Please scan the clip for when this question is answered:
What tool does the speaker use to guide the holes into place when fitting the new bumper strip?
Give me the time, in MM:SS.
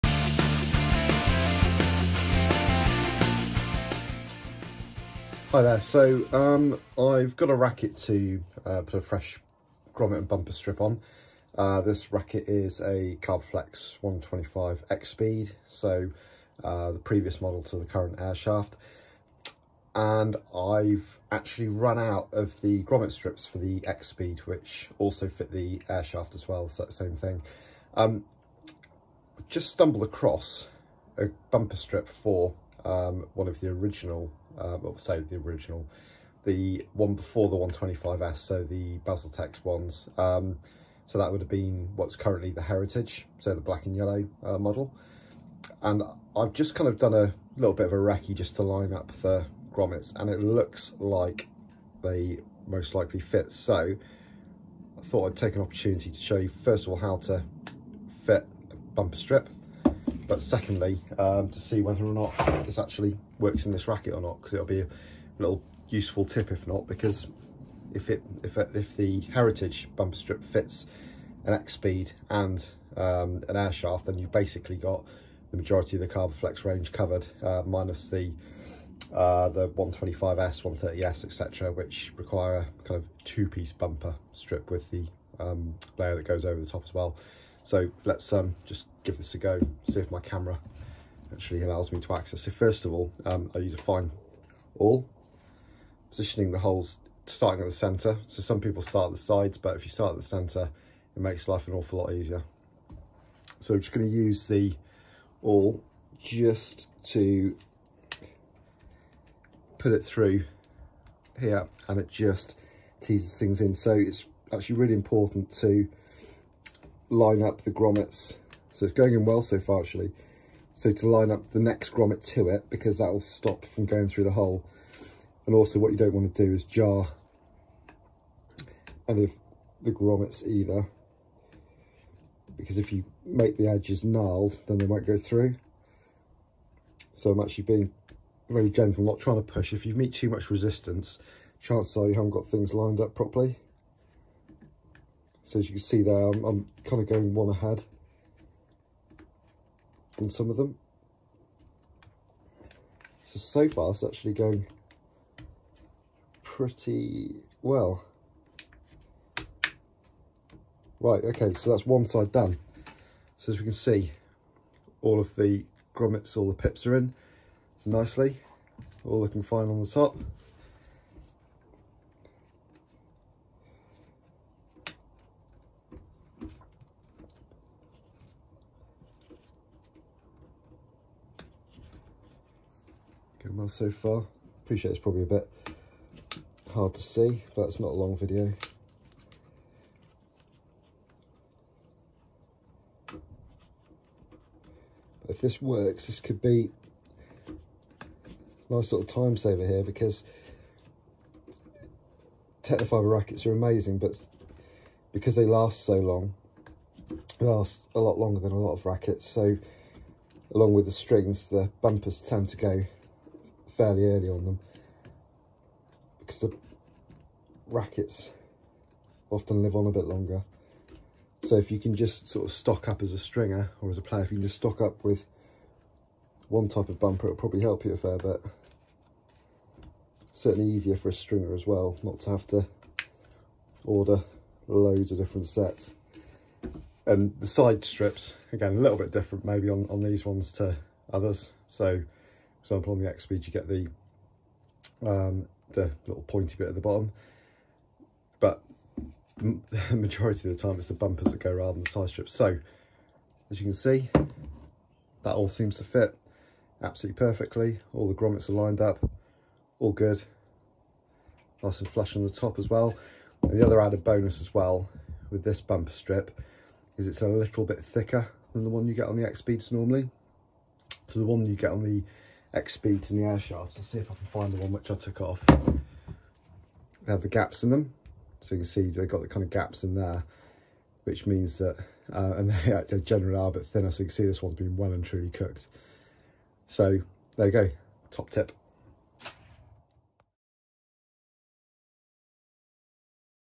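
01:33.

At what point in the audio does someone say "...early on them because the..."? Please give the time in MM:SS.
03:34.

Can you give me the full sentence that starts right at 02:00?
So to line up the next grommet to it because that will stop from going through the hole.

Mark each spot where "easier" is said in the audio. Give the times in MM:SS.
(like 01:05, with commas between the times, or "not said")
01:42, 03:50.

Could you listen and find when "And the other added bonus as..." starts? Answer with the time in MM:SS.
04:23.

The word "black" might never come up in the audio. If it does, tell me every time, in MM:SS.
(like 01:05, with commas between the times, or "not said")
00:43.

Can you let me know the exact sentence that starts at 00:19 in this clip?
And I've actually run out of the grommet strips for the X-Speed, which also fit the Airshaft as well, so same thing.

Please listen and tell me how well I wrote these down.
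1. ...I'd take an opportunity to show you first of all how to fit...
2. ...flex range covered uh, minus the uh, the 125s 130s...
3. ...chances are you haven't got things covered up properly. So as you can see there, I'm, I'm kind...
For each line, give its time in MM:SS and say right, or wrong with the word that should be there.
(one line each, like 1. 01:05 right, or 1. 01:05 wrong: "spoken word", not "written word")
1. 00:55 right
2. 01:16 right
3. 02:21 wrong: "lined", not "covered".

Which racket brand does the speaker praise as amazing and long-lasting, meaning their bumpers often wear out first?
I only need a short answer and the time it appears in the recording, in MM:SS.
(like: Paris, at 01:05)
Tecnifibre, at 03:22.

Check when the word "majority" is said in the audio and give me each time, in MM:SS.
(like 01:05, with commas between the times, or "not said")
01:15, 04:09.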